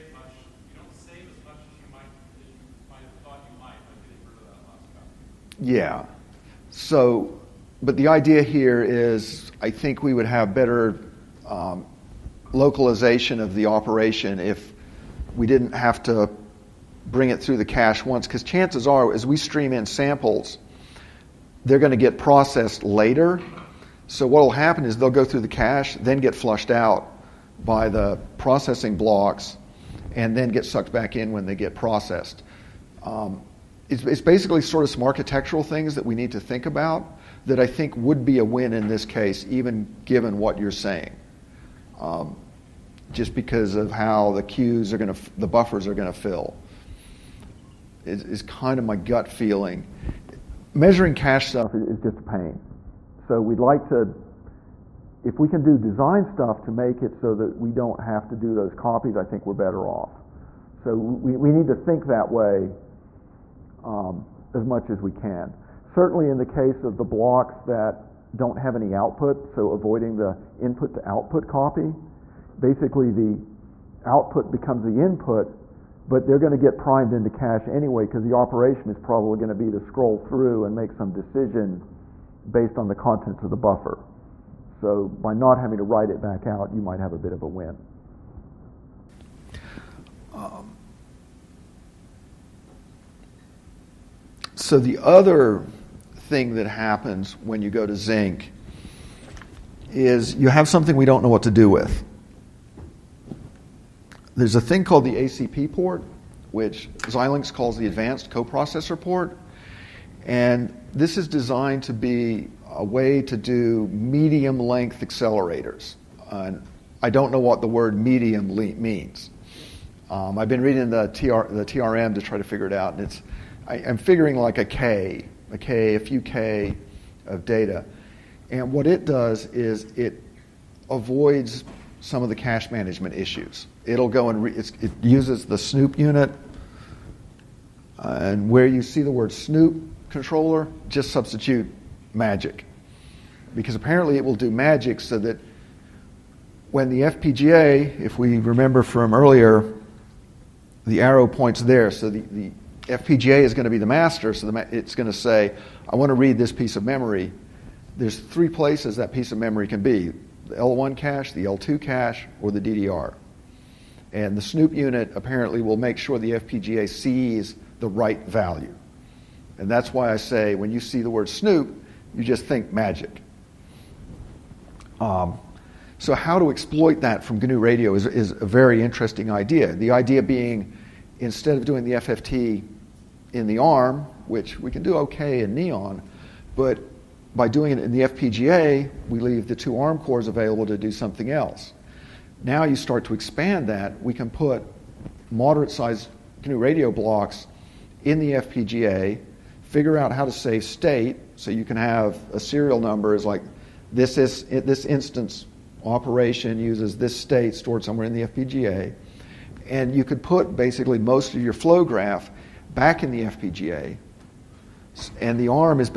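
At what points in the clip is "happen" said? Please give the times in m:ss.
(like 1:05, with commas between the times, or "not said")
0:24, 1:36.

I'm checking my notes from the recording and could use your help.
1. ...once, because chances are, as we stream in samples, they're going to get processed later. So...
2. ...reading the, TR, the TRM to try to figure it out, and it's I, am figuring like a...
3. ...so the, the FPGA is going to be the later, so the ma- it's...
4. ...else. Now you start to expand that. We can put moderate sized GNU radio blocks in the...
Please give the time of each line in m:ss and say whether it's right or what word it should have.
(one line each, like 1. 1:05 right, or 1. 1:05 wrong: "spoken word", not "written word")
1. 0:18 right
2. 2:00 right
3. 2:31 wrong: "master", not "later"
4. 3:11 right.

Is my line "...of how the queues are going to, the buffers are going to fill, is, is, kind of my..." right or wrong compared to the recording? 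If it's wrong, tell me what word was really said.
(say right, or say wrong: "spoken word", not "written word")
right.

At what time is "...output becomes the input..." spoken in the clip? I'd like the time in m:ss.
1:14.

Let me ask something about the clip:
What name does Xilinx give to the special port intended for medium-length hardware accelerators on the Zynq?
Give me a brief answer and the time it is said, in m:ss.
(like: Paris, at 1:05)
Advanced coprocessor port, at 1:47.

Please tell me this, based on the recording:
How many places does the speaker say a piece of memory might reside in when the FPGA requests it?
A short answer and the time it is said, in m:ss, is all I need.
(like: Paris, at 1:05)
3, at 2:38.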